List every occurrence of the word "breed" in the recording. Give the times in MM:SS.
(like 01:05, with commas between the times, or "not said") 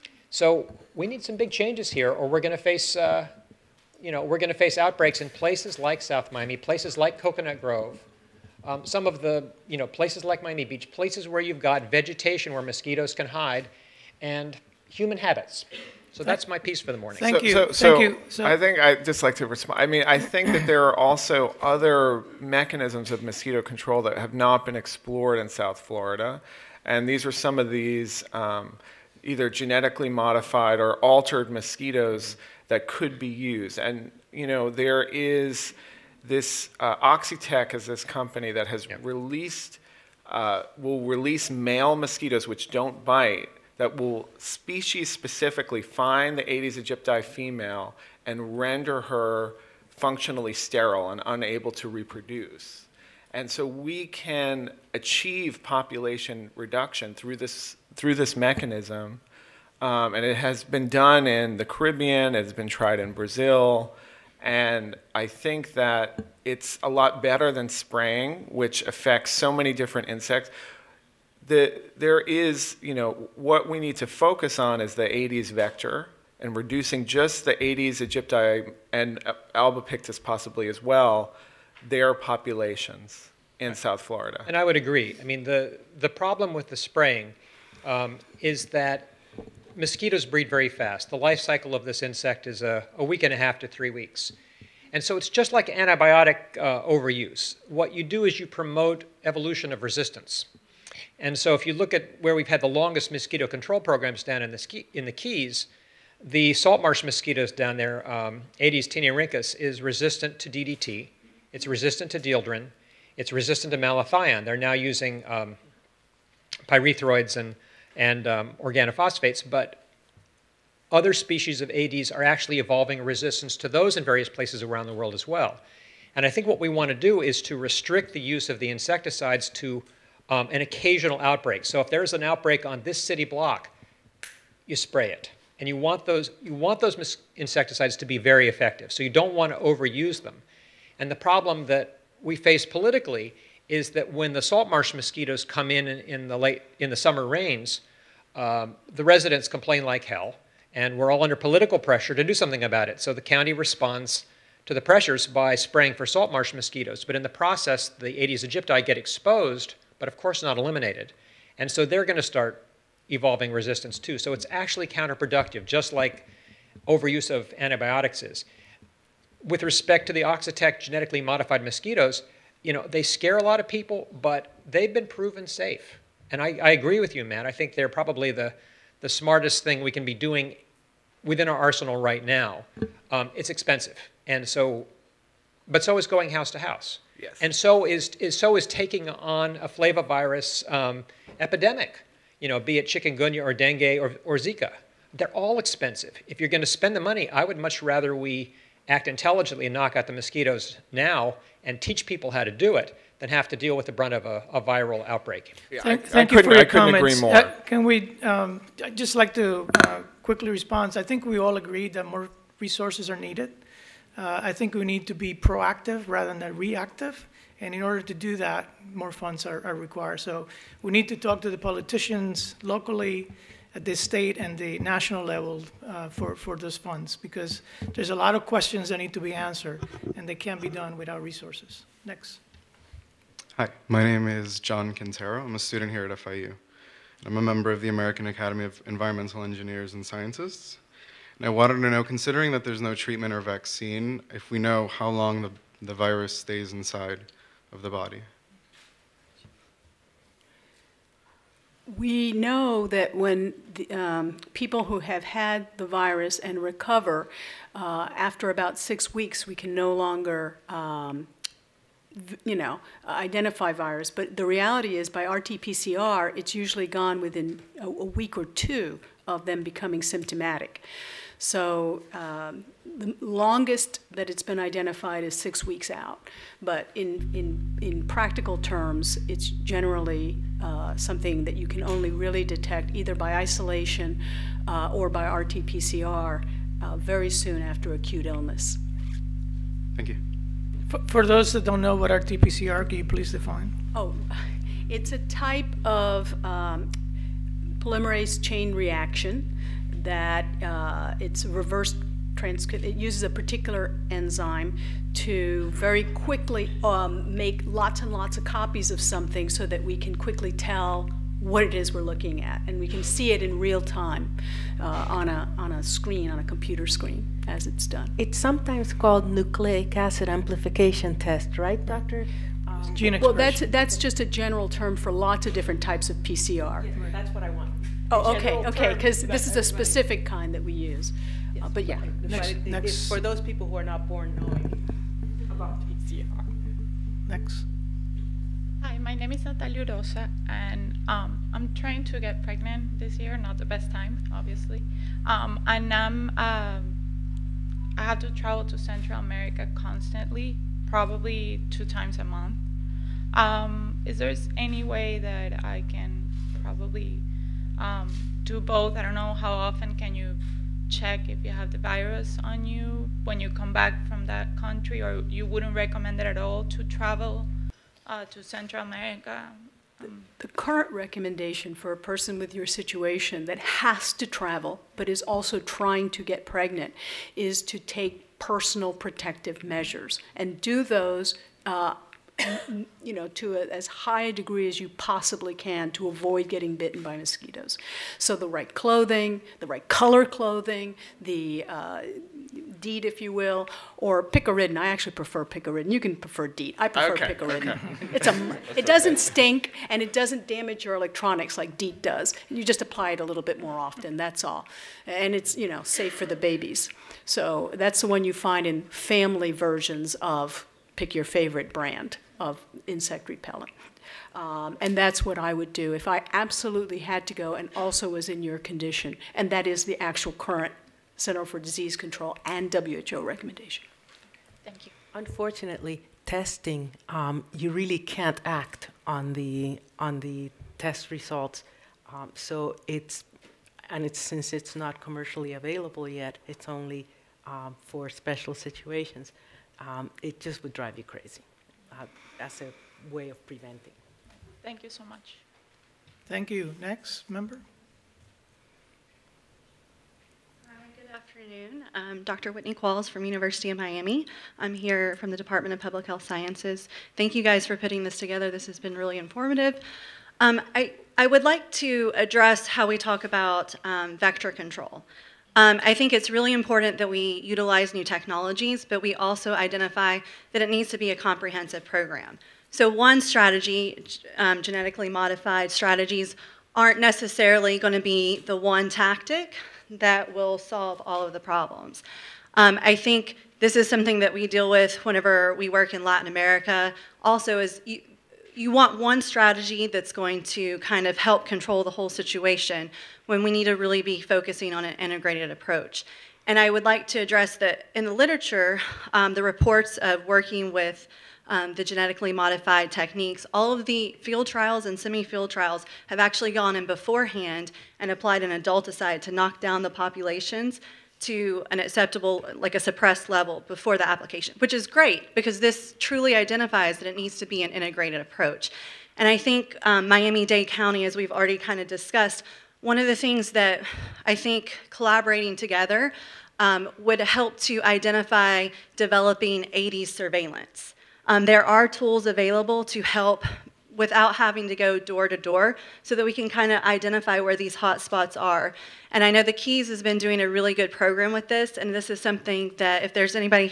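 01:30.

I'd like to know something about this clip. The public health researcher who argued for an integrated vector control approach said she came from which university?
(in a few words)
University of Miami.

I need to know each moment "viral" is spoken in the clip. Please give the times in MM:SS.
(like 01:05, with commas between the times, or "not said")
03:24.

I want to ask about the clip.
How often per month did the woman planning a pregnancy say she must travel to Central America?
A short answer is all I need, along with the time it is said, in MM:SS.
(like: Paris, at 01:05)
2 times, at 05:51.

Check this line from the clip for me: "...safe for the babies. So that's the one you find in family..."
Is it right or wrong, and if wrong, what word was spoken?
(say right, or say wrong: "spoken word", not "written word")
right.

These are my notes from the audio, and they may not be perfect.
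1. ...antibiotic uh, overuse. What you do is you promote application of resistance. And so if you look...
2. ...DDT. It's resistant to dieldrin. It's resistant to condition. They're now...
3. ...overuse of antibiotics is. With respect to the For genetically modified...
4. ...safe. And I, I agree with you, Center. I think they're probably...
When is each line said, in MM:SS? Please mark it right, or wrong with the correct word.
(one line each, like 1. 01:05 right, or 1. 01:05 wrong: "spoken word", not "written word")
1. 01:35 wrong: "evolution", not "application"
2. 01:50 wrong: "malathion", not "condition"
3. 02:46 wrong: "Oxitec", not "For"
4. 02:55 wrong: "Matt", not "Center".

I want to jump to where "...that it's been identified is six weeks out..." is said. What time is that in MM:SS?
04:34.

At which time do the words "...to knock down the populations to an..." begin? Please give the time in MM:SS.
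08:29.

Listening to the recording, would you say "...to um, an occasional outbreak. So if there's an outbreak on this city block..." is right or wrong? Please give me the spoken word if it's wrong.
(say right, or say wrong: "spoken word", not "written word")
right.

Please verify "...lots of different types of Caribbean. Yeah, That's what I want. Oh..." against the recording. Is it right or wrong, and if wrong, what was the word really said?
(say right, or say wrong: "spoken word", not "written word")
wrong: "PCR", not "Caribbean".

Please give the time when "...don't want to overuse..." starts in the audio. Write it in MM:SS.
02:19.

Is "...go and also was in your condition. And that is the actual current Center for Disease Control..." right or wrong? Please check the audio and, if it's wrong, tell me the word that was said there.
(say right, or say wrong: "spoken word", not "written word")
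right.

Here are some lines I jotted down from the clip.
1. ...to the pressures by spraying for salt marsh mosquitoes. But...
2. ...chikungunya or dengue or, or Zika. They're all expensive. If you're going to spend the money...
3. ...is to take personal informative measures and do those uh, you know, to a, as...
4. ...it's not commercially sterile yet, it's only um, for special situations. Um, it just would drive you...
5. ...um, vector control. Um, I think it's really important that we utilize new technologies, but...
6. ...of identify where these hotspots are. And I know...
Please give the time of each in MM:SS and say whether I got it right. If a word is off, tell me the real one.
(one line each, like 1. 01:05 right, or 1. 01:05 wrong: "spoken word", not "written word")
1. 02:34 right
2. 03:12 right
3. 06:17 wrong: "protective", not "informative"
4. 07:14 wrong: "available", not "sterile"
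5. 07:43 right
6. 08:56 right.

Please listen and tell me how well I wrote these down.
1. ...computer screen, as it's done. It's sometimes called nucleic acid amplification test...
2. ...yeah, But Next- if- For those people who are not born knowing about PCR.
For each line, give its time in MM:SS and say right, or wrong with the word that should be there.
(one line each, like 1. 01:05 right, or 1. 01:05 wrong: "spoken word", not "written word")
1. 05:16 right
2. 05:31 right.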